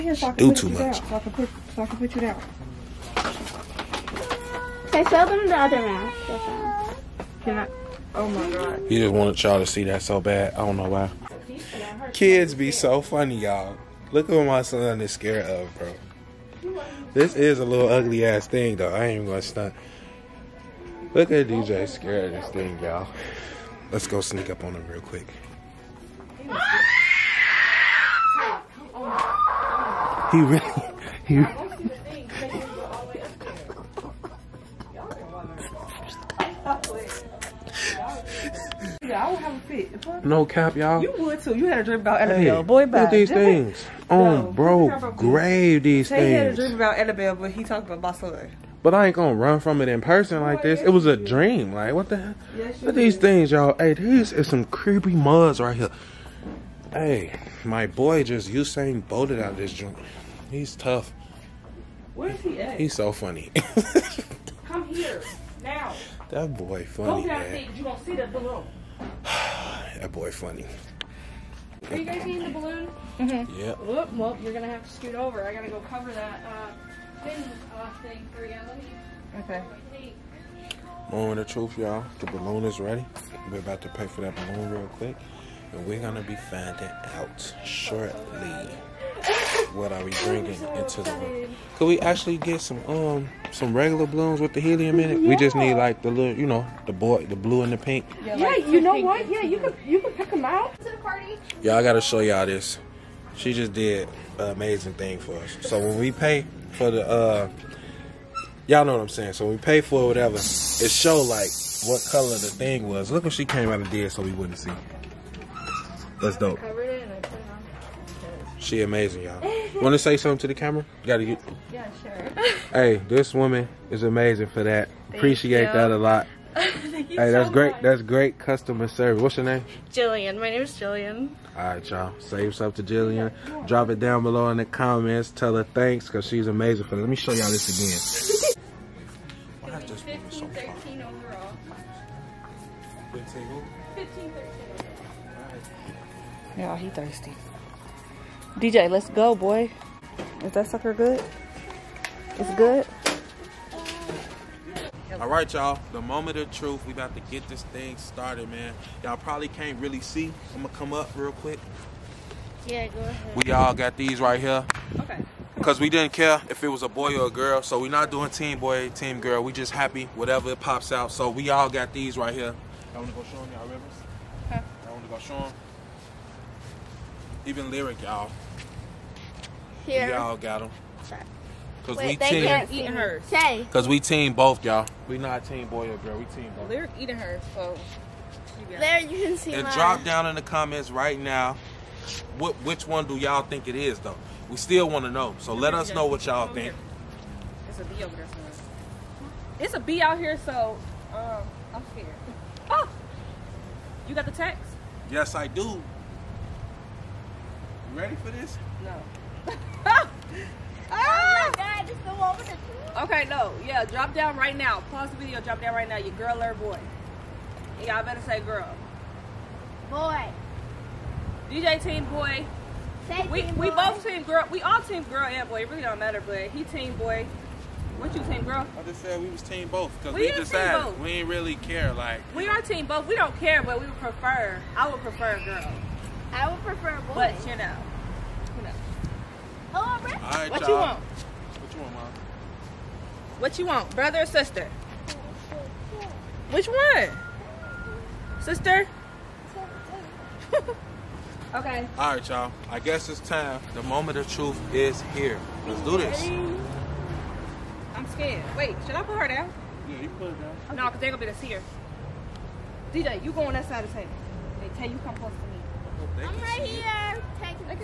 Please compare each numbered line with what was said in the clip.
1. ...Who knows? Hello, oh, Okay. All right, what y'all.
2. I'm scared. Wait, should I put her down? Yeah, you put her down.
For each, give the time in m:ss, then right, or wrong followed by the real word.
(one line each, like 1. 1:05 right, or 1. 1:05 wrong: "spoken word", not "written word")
1. 3:58 wrong: "Rick", not "Okay"
2. 4:17 right.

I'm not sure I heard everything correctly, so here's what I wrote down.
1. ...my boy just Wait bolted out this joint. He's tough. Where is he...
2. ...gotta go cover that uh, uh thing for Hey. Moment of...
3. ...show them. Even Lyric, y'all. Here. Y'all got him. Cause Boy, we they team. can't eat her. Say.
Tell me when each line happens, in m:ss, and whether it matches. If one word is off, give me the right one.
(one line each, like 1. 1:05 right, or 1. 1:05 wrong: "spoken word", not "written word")
1. 0:57 wrong: "Usain", not "Wait"
2. 1:15 wrong: "Okay", not "Hey"
3. 2:55 wrong: "Wait", not "Boy".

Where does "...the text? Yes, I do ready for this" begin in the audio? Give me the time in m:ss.
3:24.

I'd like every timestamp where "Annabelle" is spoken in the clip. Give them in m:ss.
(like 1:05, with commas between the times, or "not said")
0:42, 0:46.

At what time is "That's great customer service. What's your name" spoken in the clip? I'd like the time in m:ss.
2:07.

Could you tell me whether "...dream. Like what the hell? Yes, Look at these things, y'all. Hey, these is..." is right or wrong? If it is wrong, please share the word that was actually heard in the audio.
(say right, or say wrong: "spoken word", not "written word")
right.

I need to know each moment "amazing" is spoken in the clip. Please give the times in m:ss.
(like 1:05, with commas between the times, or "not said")
1:44, 1:58, 2:04, 2:16.